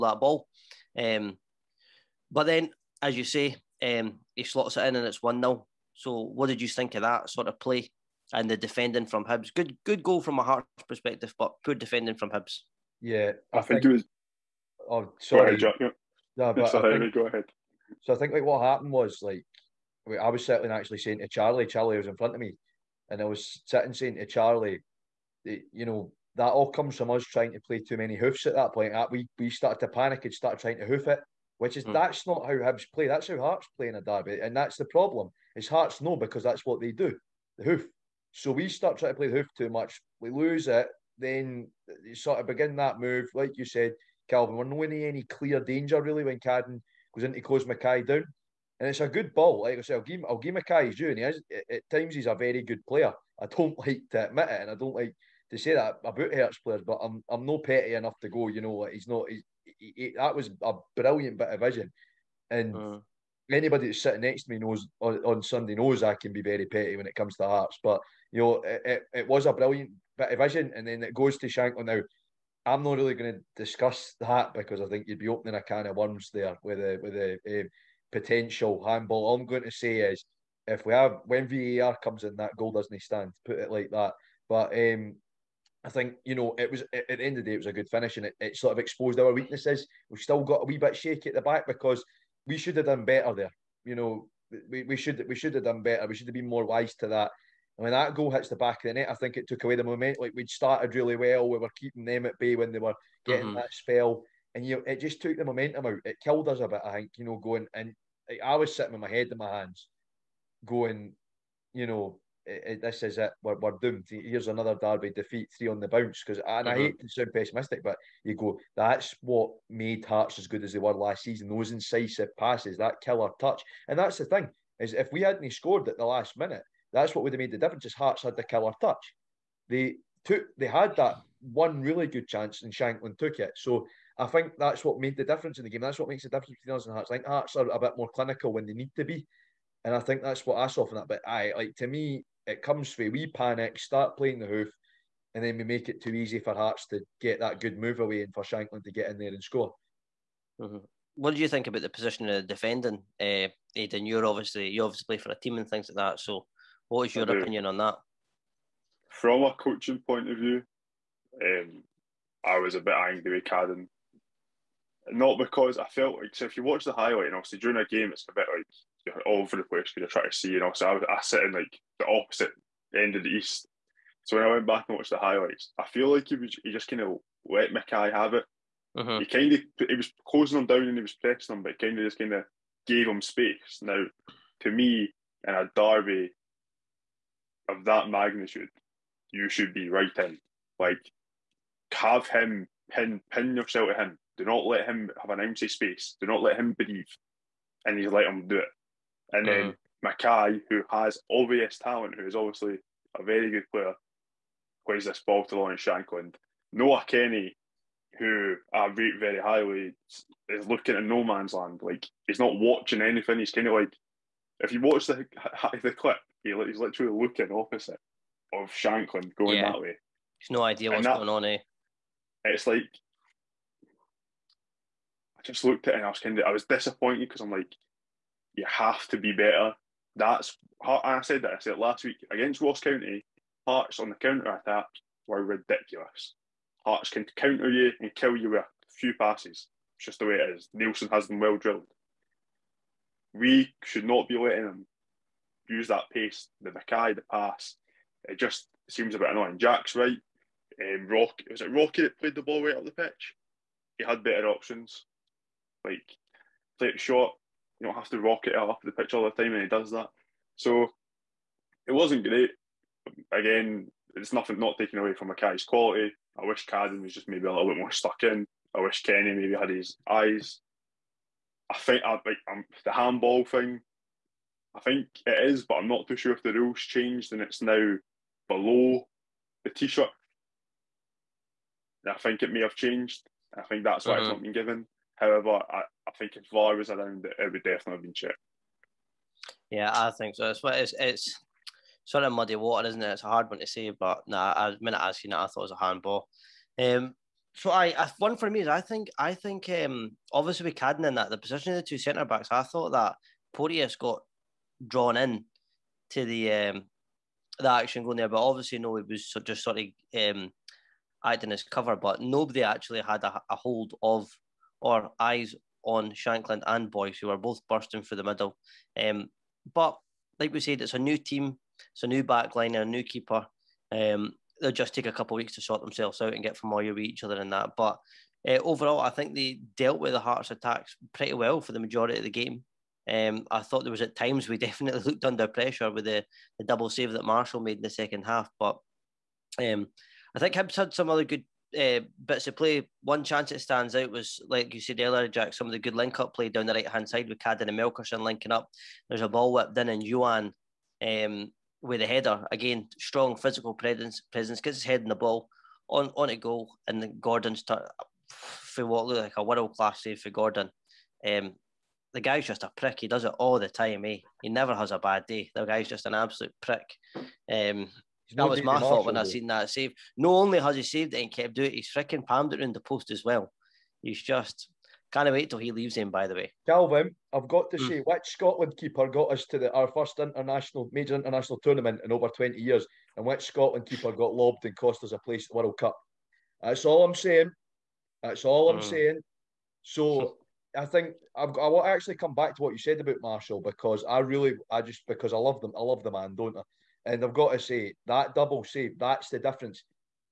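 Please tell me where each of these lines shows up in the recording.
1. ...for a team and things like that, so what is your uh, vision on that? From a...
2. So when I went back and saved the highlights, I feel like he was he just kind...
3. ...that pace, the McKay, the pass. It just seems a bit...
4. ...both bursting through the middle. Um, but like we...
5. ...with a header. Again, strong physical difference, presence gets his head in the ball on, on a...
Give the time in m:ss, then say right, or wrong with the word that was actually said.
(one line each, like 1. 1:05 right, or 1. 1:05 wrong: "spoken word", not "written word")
1. 2:35 wrong: "opinion", not "vision"
2. 2:54 wrong: "watched", not "saved"
3. 4:05 right
4. 5:17 right
5. 5:51 wrong: "presence", not "difference".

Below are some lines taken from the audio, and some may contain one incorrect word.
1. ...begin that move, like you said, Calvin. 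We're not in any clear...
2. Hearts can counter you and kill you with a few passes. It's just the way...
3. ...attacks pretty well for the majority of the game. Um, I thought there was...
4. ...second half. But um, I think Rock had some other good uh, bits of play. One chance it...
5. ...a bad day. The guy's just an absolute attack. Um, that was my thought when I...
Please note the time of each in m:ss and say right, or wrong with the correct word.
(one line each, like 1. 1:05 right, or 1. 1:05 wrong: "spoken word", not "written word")
1. 0:42 right
2. 3:56 right
3. 5:30 right
4. 5:37 wrong: "Hibs", not "Rock"
5. 6:04 wrong: "prick", not "attack".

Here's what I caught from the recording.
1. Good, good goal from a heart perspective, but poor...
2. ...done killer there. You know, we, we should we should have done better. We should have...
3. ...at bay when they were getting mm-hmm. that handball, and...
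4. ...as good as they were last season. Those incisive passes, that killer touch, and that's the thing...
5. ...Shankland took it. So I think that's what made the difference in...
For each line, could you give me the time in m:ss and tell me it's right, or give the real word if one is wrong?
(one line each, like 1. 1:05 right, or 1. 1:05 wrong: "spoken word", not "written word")
1. 0:09 right
2. 1:32 wrong: "better", not "killer"
3. 1:42 wrong: "spell", not "handball"
4. 2:00 right
5. 2:12 right.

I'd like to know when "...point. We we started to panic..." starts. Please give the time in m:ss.
0:28.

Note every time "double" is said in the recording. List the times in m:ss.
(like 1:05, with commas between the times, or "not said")
5:36, 6:38.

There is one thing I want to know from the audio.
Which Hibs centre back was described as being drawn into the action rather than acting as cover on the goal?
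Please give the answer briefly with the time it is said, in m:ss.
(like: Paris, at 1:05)
Porteous, at 5:03.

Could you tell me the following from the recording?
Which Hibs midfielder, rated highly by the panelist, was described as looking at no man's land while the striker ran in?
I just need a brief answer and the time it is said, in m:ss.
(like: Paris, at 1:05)
Nohan Kenneh, at 3:26.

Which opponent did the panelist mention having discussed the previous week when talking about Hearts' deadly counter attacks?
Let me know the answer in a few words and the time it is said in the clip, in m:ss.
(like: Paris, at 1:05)
Ross County, at 3:52.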